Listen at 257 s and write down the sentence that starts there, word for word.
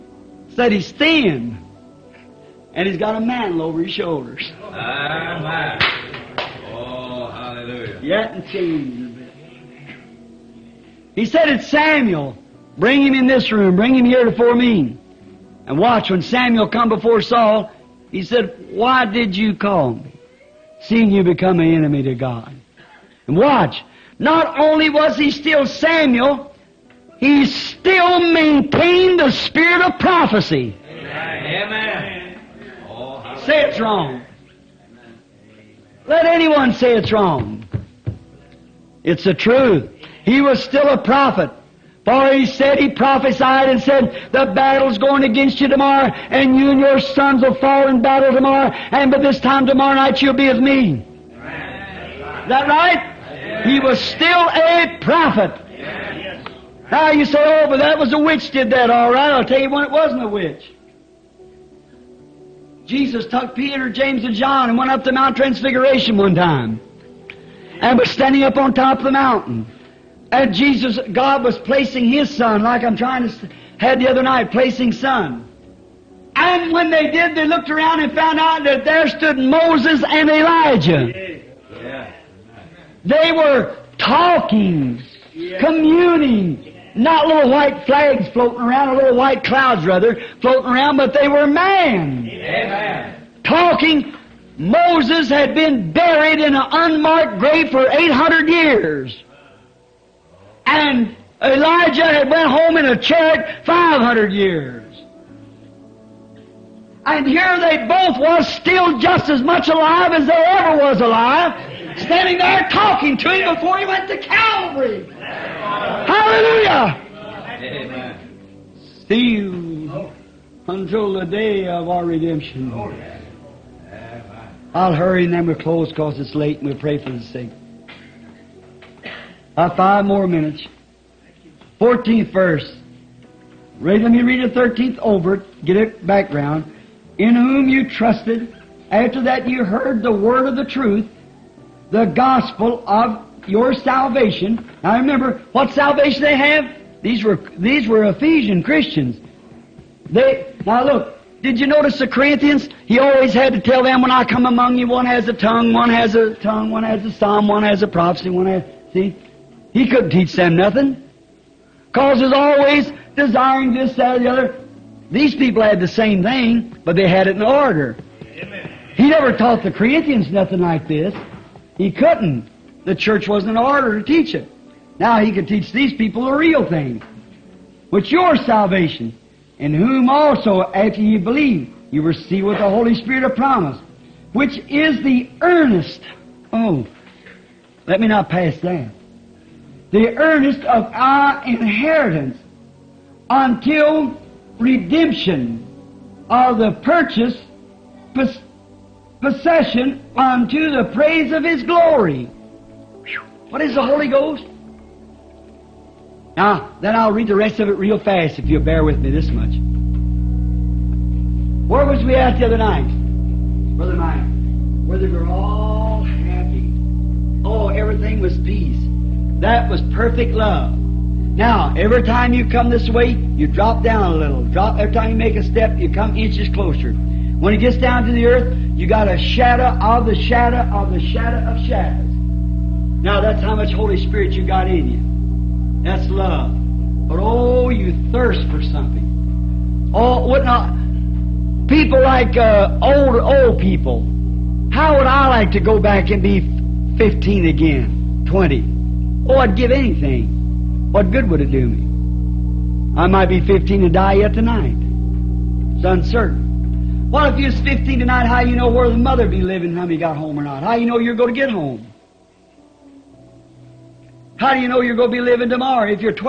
Well, if you was 15 tonight, how you know where the mother be living, how he got home or not?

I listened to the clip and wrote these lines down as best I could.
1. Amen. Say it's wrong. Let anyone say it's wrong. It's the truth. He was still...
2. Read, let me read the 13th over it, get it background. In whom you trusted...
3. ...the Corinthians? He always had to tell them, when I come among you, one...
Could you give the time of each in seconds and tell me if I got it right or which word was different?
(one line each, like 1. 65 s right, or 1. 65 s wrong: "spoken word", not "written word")
1. 31 s right
2. 133 s right
3. 151 s right.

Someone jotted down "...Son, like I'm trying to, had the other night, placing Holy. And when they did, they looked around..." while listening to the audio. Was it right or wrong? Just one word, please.
wrong.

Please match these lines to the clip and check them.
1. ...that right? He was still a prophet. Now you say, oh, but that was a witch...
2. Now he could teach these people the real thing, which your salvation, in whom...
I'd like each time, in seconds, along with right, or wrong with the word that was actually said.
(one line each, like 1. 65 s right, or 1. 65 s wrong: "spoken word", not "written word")
1. 52 s right
2. 174 s right.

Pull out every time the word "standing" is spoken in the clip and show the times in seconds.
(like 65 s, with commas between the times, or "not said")
68 s, 111 s.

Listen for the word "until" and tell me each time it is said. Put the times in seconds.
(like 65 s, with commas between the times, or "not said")
120 s, 193 s.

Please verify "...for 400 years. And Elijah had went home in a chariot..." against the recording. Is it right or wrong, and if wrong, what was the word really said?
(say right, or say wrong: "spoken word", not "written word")
wrong: "800", not "400".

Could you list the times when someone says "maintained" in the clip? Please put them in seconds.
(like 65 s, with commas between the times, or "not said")
28 s.